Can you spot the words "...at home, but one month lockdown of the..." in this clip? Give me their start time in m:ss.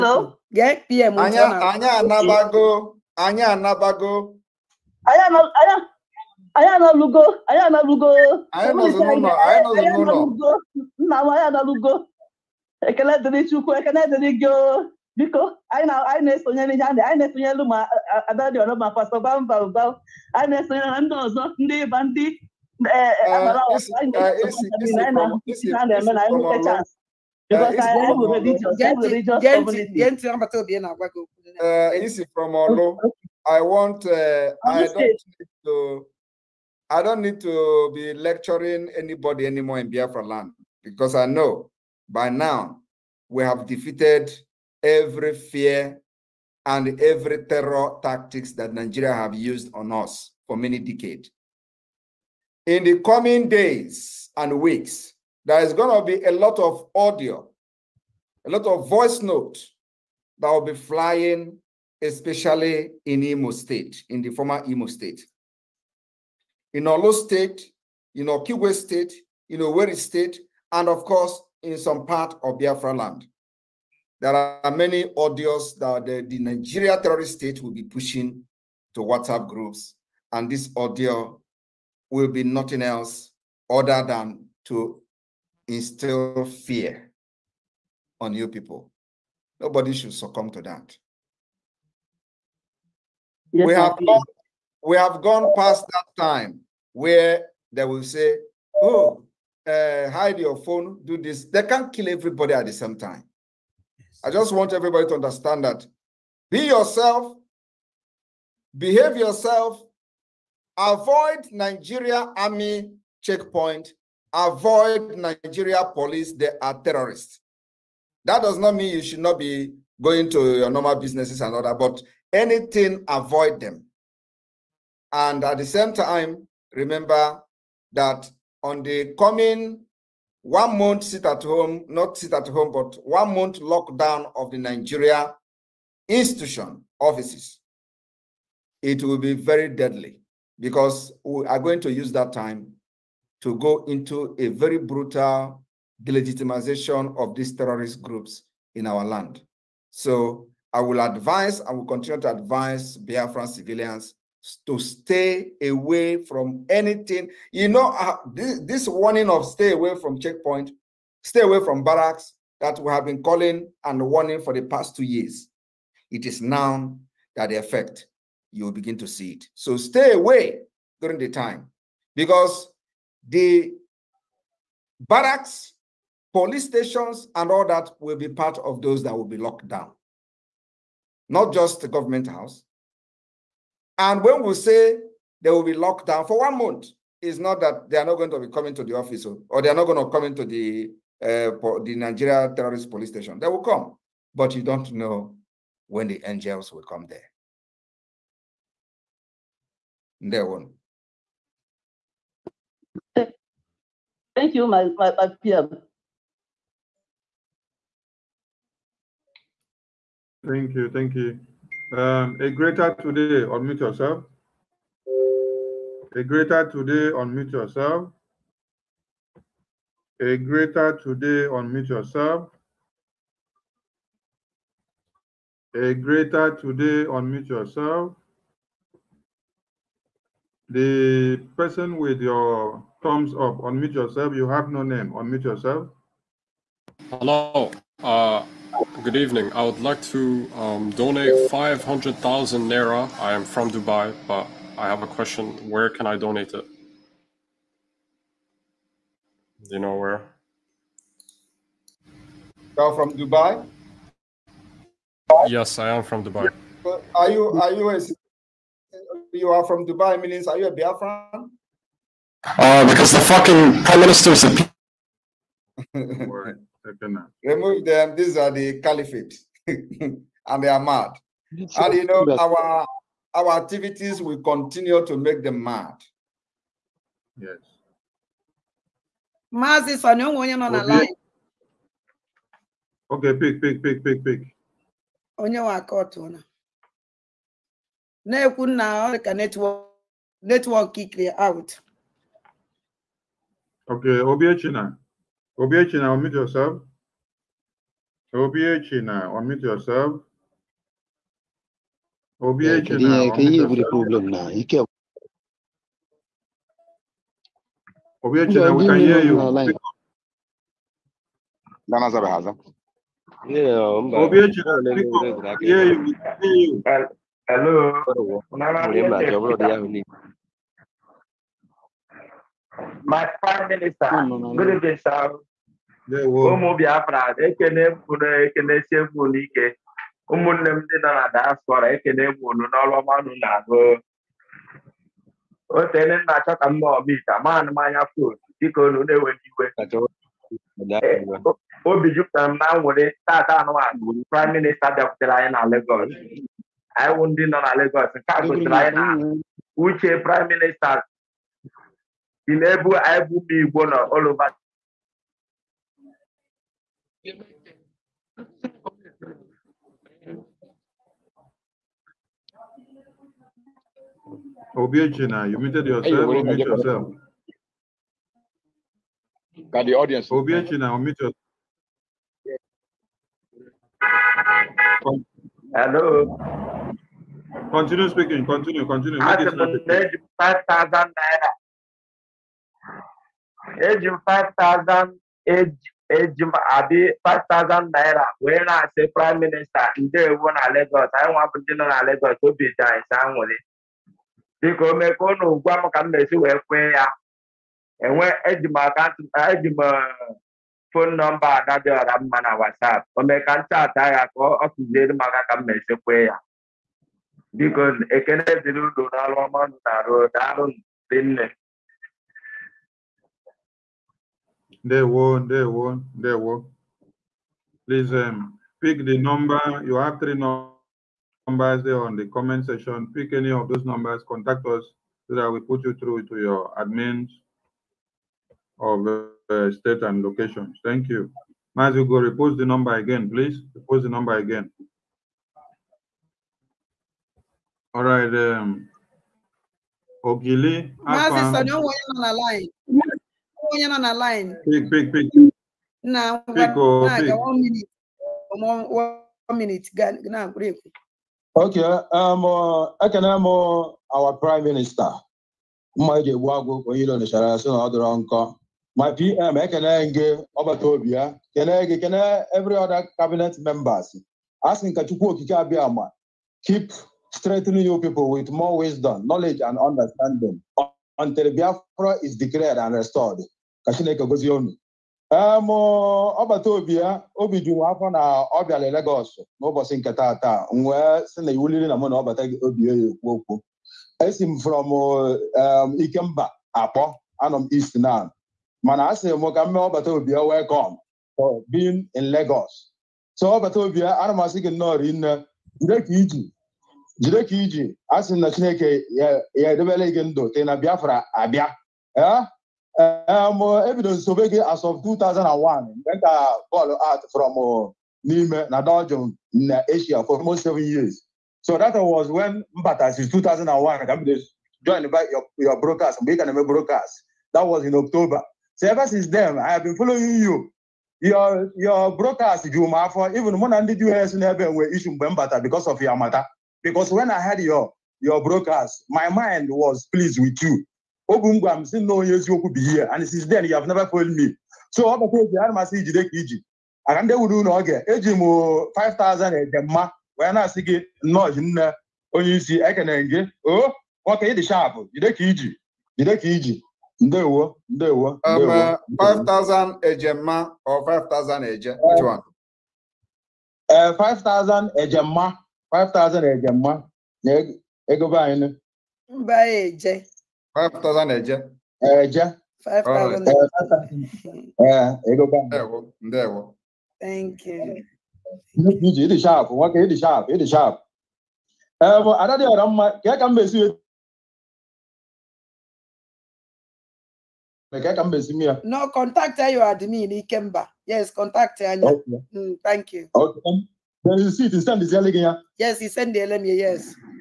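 2:12.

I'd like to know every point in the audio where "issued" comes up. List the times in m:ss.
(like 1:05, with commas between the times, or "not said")
8:44.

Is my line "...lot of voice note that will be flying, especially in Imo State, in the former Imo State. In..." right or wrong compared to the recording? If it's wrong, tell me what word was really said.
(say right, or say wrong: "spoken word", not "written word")
right.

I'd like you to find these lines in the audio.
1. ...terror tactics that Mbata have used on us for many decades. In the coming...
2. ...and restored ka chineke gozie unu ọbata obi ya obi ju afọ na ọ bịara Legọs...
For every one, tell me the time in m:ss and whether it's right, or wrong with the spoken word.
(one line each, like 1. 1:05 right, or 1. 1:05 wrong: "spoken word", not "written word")
1. 0:47 wrong: "Nigeria", not "Mbata"
2. 7:52 right.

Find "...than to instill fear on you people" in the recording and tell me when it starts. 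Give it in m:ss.
1:24.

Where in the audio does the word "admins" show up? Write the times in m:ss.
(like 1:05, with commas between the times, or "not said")
7:06, 9:39.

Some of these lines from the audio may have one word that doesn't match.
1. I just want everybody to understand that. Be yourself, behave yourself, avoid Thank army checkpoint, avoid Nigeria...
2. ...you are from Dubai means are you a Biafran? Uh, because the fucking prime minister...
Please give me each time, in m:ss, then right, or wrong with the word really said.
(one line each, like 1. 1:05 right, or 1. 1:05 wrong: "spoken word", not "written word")
1. 1:44 wrong: "Nigeria", not "Thank"
2. 4:19 right.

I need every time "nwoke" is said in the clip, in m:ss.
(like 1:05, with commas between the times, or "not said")
9:04, 9:29.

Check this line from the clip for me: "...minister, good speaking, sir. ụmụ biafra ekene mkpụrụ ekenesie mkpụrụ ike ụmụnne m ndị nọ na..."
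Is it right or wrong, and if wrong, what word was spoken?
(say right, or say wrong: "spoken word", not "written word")
wrong: "evening", not "speaking".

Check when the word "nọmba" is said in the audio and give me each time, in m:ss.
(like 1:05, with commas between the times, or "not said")
6:41.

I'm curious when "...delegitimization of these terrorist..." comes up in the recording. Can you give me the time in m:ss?
2:26.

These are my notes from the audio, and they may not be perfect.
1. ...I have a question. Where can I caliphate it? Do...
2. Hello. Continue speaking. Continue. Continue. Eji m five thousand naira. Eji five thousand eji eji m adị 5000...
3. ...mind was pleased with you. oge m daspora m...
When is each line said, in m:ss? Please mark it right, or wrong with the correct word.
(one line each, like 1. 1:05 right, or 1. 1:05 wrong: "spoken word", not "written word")
1. 4:04 wrong: "donate", not "caliphate"
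2. 6:15 right
3. 8:49 wrong: "gwara", not "daspora".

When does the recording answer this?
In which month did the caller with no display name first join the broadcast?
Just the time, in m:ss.
8:37.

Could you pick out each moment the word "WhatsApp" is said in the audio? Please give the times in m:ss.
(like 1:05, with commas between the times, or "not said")
1:19, 6:42.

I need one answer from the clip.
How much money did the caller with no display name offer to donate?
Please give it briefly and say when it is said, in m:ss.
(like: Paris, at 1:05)
500,000 Naira, at 4:01.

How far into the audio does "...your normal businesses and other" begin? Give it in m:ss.
2:00.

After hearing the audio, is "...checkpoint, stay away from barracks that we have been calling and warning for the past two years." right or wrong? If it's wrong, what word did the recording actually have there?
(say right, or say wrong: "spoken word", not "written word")
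right.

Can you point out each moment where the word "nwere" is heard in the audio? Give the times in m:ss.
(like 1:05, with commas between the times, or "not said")
5:42, 6:33.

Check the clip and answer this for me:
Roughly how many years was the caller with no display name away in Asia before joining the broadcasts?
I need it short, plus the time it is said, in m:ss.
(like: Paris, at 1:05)
seven years, at 8:30.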